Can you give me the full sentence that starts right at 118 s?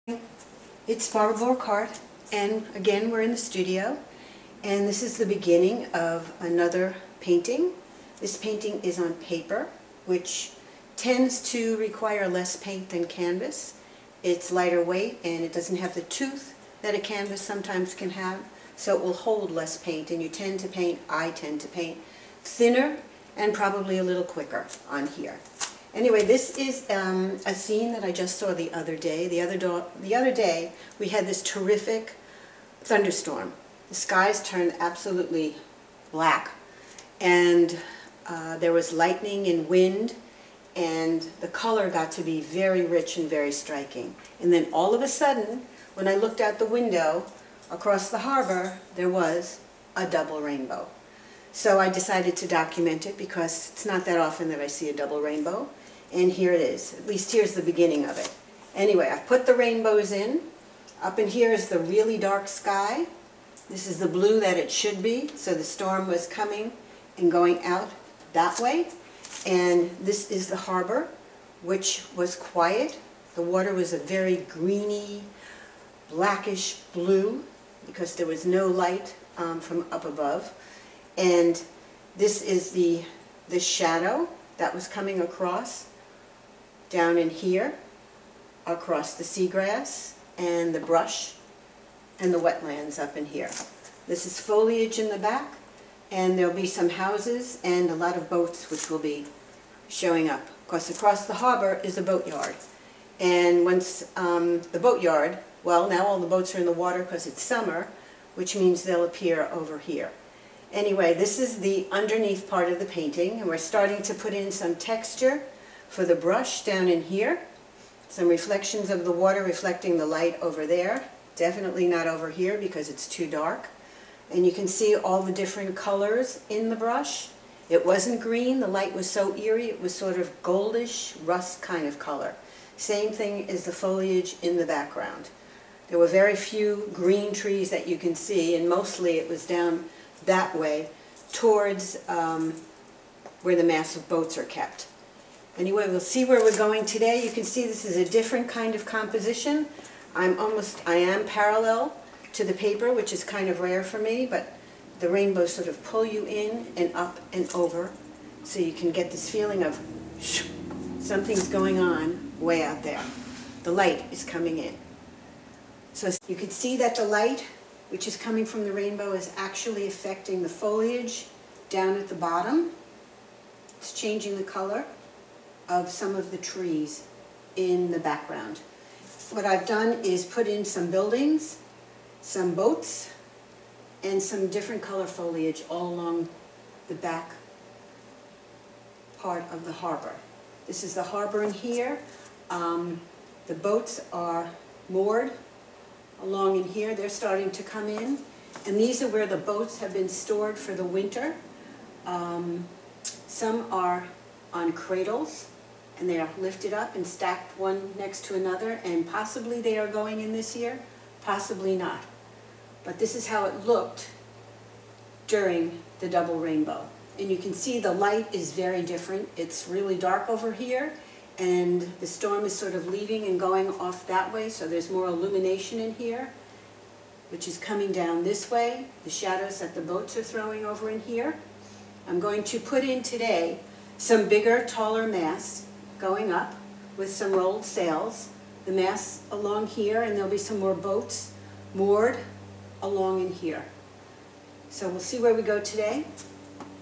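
Some reflections of the water reflecting the light over there.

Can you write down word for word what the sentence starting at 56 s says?
At least here's the beginning of it.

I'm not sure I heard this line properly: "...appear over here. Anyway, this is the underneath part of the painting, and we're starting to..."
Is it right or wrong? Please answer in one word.
right.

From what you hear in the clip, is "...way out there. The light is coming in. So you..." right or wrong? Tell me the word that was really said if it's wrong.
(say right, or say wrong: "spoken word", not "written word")
right.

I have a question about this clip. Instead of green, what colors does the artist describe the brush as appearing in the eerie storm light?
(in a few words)
Goldish, rust.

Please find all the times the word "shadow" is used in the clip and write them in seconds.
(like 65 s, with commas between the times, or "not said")
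83 s, 229 s.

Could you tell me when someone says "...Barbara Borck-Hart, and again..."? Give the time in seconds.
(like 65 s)
1 s.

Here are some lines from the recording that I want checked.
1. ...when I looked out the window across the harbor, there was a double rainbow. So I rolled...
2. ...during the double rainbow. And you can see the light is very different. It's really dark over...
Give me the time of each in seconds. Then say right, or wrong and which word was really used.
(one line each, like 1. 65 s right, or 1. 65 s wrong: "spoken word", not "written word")
1. 45 s wrong: "decided", not "rolled"
2. 215 s right.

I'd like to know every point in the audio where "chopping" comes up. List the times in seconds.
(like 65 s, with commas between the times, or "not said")
not said.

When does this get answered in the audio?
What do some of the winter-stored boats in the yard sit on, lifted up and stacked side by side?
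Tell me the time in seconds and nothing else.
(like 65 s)
204 s.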